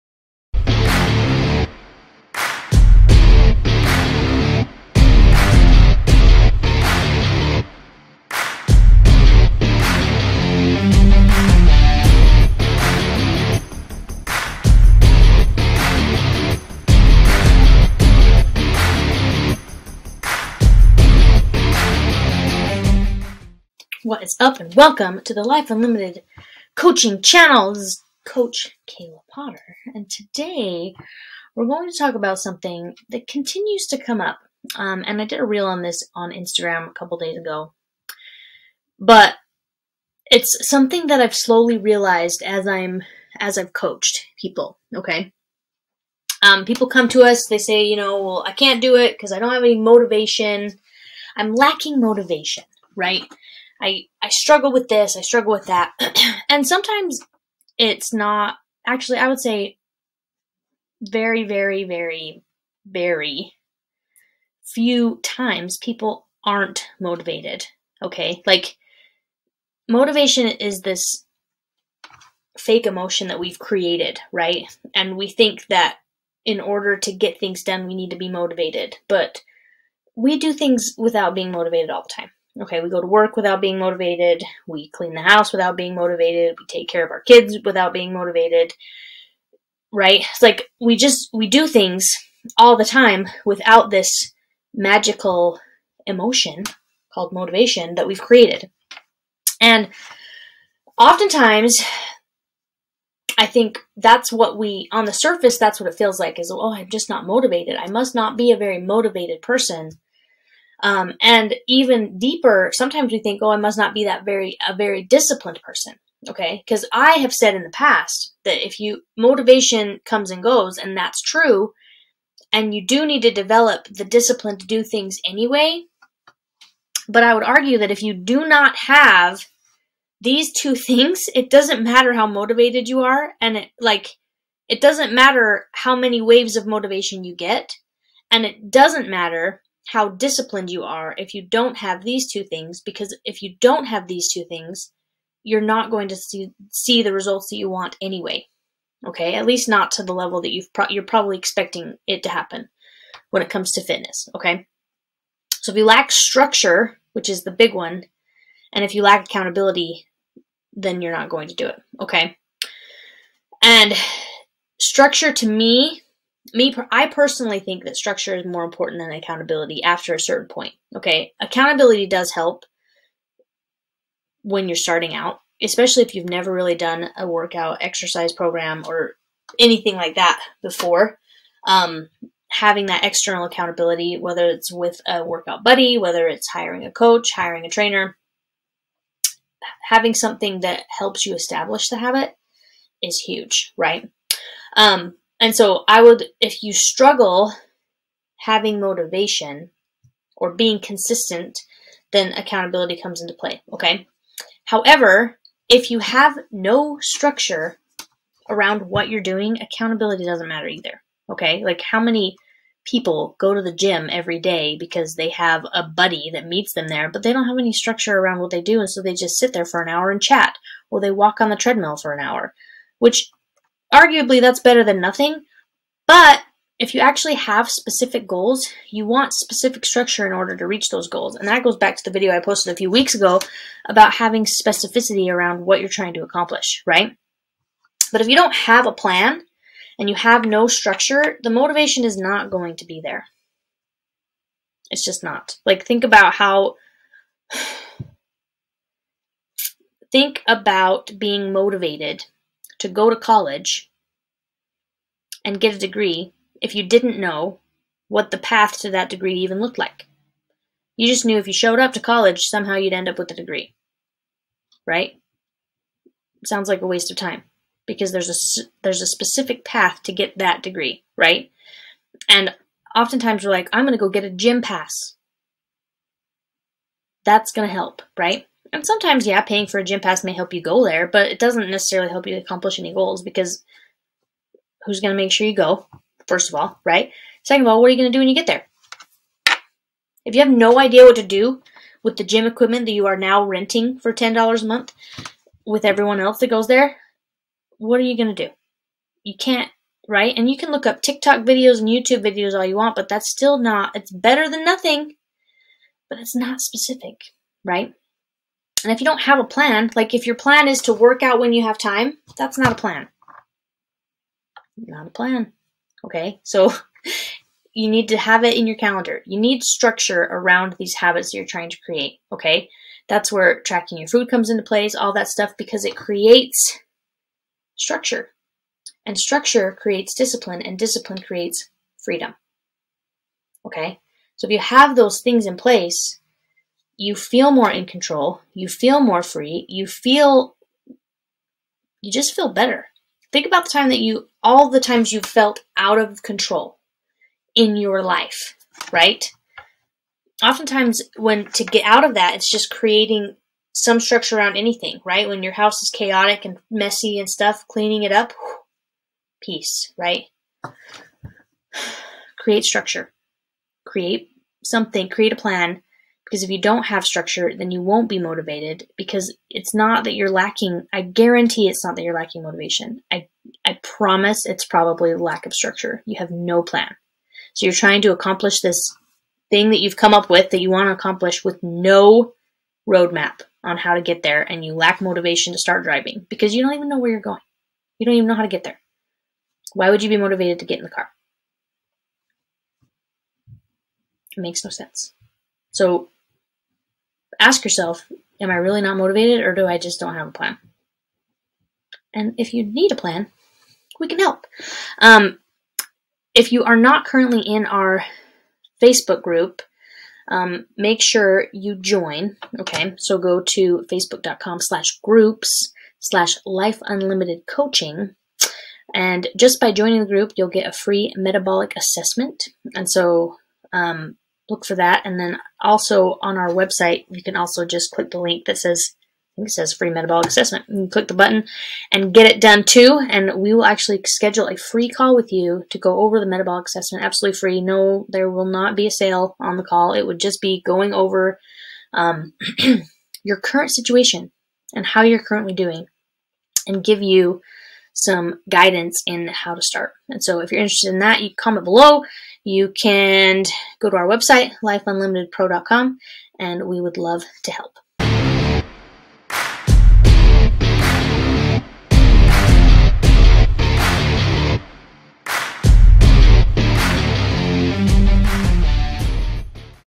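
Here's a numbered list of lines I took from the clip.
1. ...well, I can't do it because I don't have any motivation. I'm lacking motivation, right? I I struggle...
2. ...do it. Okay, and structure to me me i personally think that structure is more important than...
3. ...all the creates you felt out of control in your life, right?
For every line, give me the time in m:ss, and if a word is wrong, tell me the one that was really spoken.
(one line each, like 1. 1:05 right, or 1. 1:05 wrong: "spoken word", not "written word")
1. 0:48 right
2. 2:41 right
3. 5:44 wrong: "times", not "creates".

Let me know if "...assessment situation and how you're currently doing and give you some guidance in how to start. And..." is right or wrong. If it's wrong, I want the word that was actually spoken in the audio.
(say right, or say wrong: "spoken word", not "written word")
wrong: "current", not "assessment".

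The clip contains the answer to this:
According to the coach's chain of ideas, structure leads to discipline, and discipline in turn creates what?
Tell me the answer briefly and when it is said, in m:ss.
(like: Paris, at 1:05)
Freedom, at 5:30.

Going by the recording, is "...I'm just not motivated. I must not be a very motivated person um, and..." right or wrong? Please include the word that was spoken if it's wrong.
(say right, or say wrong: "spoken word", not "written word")
right.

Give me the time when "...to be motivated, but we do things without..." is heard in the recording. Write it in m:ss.
1:18.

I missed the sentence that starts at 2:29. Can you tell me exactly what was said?
Okay, at least not to the level that you've pro you're probably expecting it to happen when it comes to fitness.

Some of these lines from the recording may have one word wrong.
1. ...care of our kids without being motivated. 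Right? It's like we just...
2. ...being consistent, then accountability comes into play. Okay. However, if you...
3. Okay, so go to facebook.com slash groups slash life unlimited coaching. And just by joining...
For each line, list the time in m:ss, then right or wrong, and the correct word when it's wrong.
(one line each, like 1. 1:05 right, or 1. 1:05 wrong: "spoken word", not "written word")
1. 1:26 right
2. 3:20 right
3. 6:52 right.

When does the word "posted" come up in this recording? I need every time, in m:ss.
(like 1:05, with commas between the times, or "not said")
3:52.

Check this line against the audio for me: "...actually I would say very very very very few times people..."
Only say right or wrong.
right.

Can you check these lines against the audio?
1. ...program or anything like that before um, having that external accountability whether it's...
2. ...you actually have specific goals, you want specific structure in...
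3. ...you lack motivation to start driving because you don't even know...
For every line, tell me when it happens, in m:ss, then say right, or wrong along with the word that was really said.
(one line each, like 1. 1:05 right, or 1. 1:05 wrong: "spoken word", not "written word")
1. 2:58 right
2. 3:46 right
3. 6:24 right.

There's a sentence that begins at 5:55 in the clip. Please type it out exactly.
When your house is chaotic and messy and stuff, cleaning it up, peace, right?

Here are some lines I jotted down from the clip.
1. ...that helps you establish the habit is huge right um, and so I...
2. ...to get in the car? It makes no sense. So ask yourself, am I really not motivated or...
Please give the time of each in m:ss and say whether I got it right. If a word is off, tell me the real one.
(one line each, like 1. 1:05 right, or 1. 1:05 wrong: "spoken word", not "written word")
1. 3:10 right
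2. 6:30 right.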